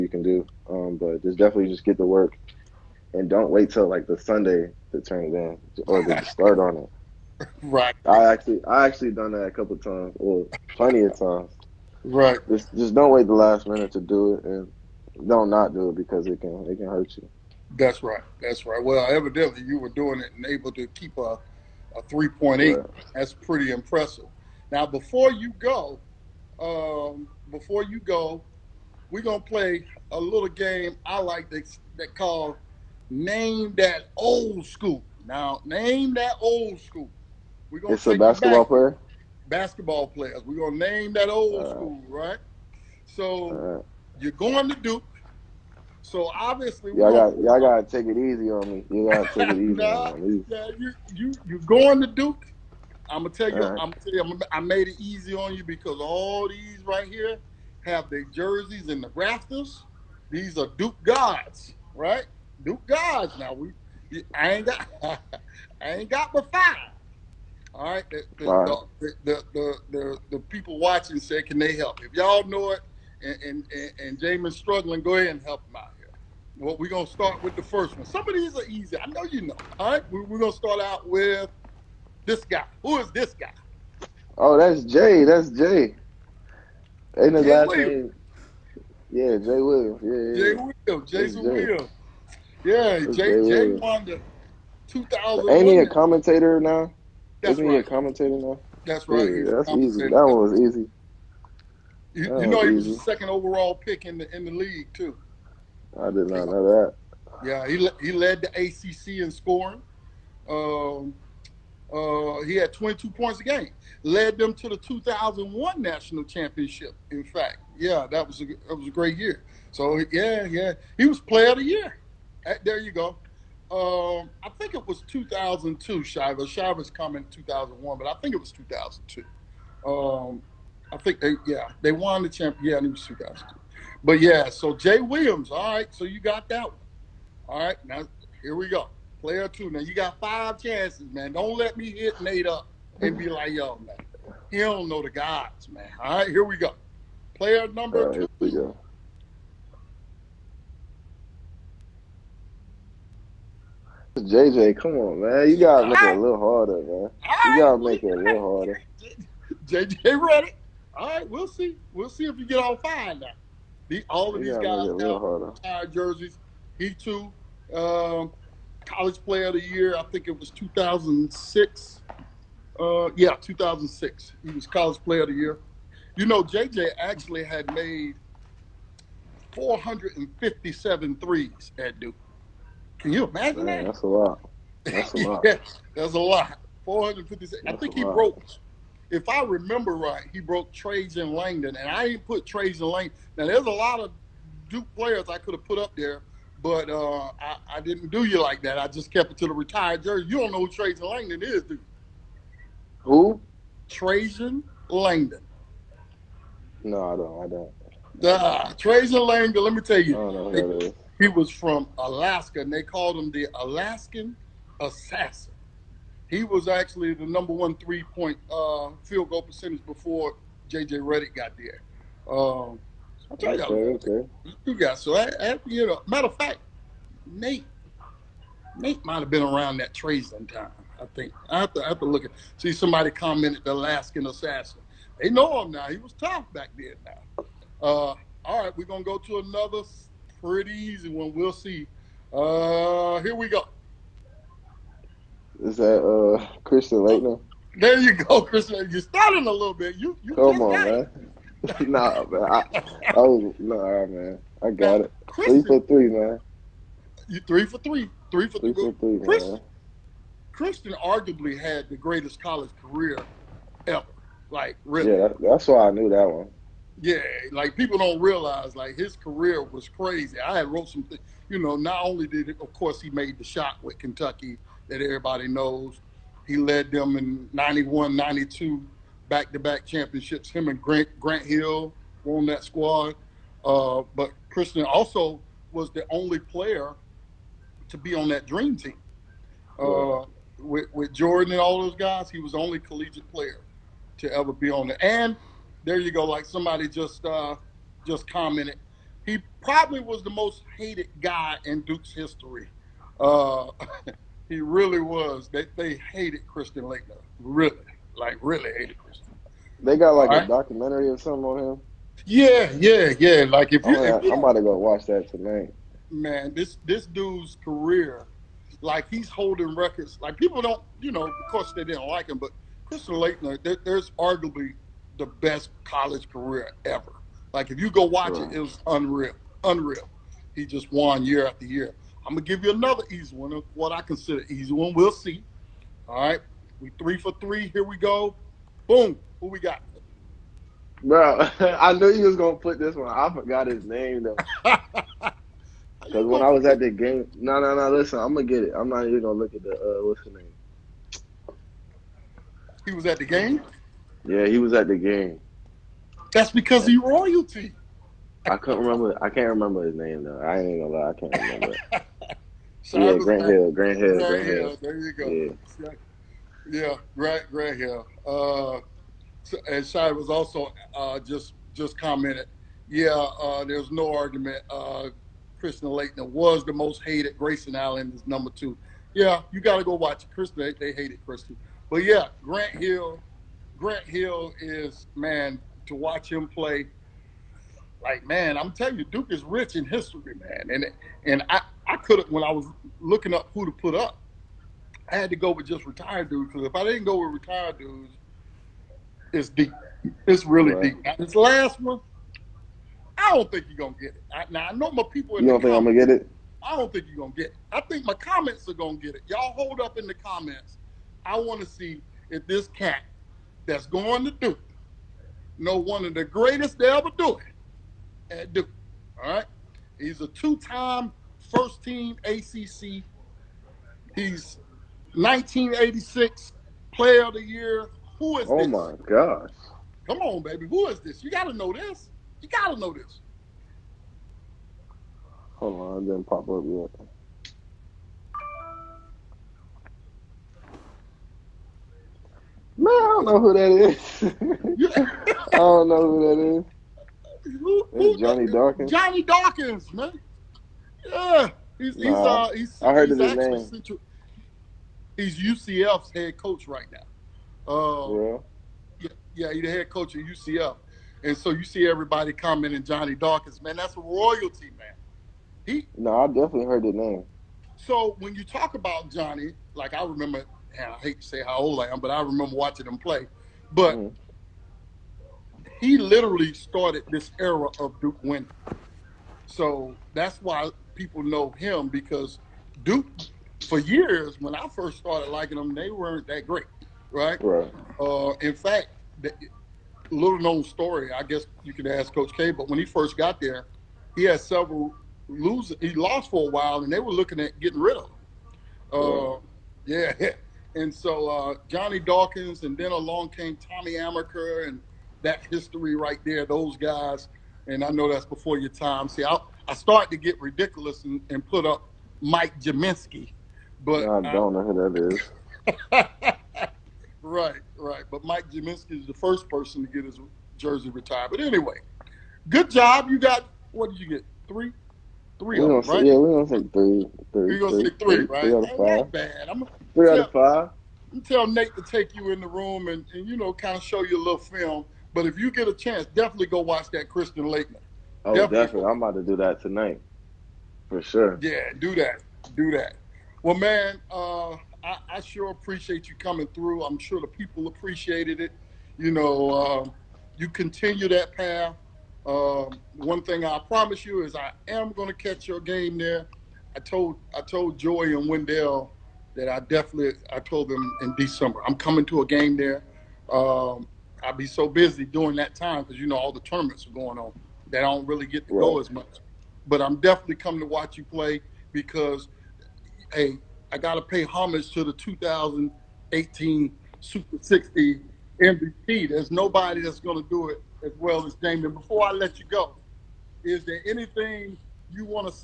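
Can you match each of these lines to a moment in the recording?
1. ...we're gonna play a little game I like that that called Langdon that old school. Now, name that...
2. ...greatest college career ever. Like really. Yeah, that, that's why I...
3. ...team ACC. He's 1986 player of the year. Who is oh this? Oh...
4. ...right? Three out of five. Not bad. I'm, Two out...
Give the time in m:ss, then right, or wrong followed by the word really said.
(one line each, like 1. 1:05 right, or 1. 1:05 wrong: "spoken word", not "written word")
1. 0:29 wrong: "Name", not "Langdon"
2. 4:21 right
3. 7:01 right
4. 8:48 wrong: "Three", not "Two".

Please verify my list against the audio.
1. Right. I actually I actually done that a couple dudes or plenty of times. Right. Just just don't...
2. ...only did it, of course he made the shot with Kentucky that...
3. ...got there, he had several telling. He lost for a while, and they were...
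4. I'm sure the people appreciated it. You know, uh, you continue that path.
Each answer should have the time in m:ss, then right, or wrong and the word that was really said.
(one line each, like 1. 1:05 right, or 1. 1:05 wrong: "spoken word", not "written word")
1. 0:07 wrong: "times", not "dudes"
2. 4:32 right
3. 8:13 wrong: "losing", not "telling"
4. 9:06 right.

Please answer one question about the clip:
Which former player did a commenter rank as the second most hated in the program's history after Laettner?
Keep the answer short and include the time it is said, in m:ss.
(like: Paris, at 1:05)
Grayson Allen, at 6:17.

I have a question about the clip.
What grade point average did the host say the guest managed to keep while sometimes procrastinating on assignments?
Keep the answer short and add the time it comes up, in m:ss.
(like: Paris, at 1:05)
3.8, at 0:22.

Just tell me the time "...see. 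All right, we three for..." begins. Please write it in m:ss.
5:35.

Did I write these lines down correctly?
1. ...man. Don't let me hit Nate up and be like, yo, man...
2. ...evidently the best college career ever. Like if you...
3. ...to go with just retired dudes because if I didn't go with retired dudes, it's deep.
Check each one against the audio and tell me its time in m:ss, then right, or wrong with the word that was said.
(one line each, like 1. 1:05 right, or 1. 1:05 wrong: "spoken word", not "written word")
1. 2:21 right
2. 5:24 wrong: "arguably", not "evidently"
3. 6:35 right.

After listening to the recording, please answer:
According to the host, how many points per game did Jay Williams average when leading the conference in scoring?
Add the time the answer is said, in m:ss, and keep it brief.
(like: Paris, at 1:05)
22, at 1:52.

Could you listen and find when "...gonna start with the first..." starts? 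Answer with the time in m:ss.
1:16.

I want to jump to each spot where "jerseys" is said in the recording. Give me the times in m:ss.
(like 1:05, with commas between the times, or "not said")
0:58, 2:45, 3:20, 8:40.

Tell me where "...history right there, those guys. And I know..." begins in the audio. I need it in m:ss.
8:25.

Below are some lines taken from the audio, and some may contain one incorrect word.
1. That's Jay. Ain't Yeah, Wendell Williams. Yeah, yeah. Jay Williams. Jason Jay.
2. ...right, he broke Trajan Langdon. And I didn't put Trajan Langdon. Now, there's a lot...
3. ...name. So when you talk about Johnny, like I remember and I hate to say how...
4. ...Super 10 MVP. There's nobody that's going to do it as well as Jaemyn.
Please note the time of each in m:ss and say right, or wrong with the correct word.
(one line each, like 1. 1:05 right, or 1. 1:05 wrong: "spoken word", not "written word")
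1. 1:25 wrong: "Jay", not "Wendell"
2. 3:09 right
3. 7:46 right
4. 9:36 wrong: "60", not "10".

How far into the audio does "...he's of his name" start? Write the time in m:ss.
7:33.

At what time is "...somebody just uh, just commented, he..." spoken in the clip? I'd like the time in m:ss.
4:56.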